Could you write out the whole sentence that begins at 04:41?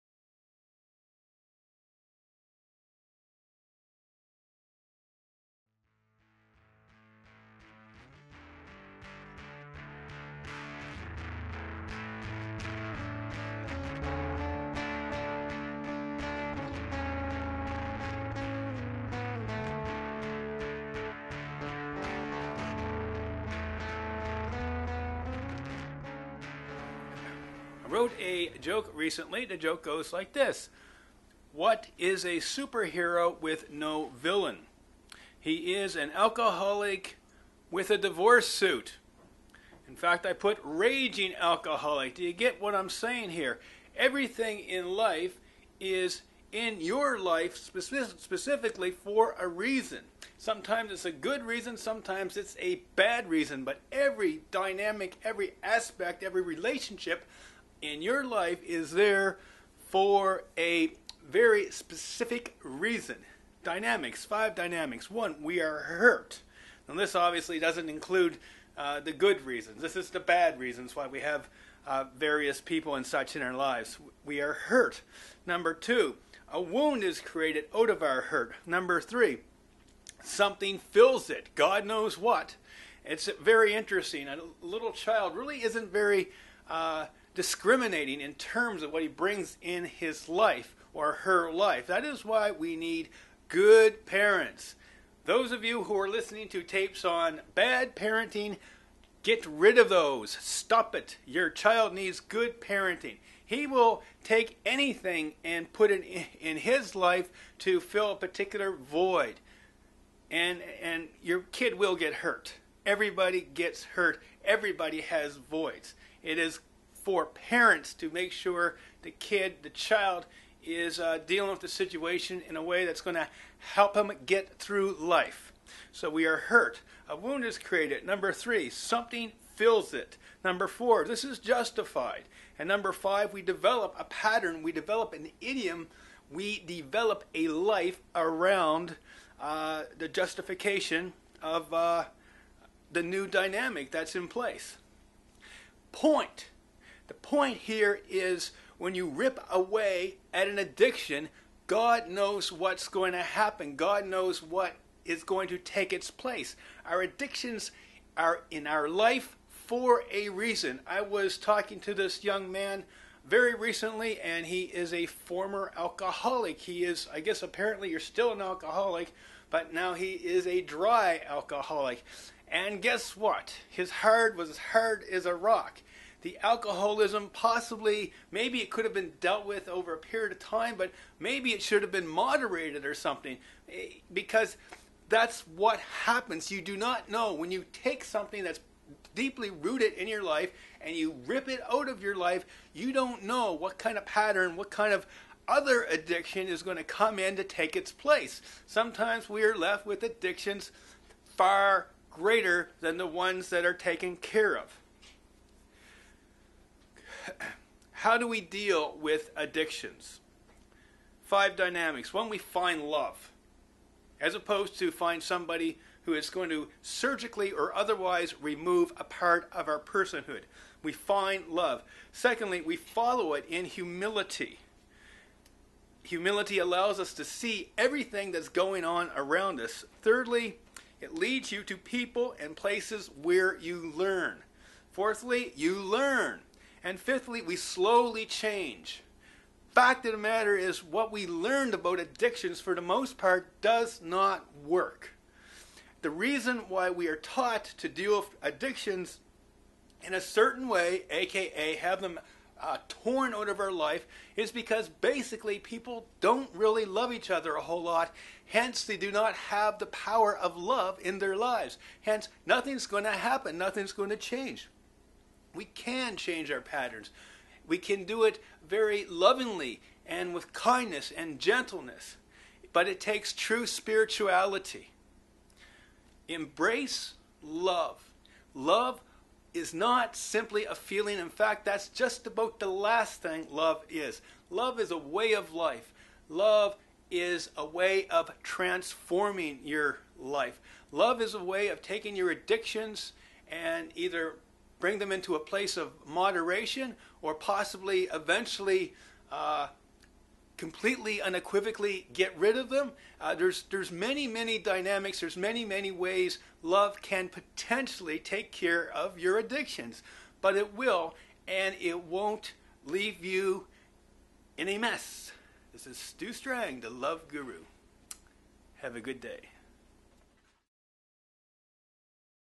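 In fact, that's just about the last thing love is.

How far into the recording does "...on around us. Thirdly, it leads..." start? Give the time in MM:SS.
03:48.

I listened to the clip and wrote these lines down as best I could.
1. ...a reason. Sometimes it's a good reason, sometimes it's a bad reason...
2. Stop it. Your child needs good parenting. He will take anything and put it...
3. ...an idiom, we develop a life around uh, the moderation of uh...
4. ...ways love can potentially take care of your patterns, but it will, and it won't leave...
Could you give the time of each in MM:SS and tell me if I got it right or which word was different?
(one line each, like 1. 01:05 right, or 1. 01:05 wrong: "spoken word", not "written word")
1. 00:49 right
2. 01:40 right
3. 02:15 wrong: "justification", not "moderation"
4. 05:05 wrong: "addictions", not "patterns".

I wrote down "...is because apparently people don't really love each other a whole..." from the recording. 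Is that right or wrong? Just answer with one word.
wrong.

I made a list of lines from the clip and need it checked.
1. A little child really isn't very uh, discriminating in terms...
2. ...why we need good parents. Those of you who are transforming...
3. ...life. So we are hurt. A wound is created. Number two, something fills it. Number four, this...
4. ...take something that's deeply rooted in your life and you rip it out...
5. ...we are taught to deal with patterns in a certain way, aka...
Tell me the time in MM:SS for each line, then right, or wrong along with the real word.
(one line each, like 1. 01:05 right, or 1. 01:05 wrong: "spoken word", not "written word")
1. 01:24 right
2. 01:32 wrong: "listening", not "transforming"
3. 02:04 wrong: "three", not "two"
4. 03:07 right
5. 04:06 wrong: "addictions", not "patterns".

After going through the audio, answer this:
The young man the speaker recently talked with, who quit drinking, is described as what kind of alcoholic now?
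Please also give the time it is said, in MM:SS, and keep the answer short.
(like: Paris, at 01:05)
dry alcoholic, at 02:50.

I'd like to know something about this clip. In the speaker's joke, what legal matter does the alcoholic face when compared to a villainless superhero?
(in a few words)
divorce suit.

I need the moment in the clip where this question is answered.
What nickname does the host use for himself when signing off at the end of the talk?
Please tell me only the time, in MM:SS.
05:16.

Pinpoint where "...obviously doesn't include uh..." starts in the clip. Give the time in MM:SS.
01:07.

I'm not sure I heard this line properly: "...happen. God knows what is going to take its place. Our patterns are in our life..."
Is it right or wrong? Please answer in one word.
wrong.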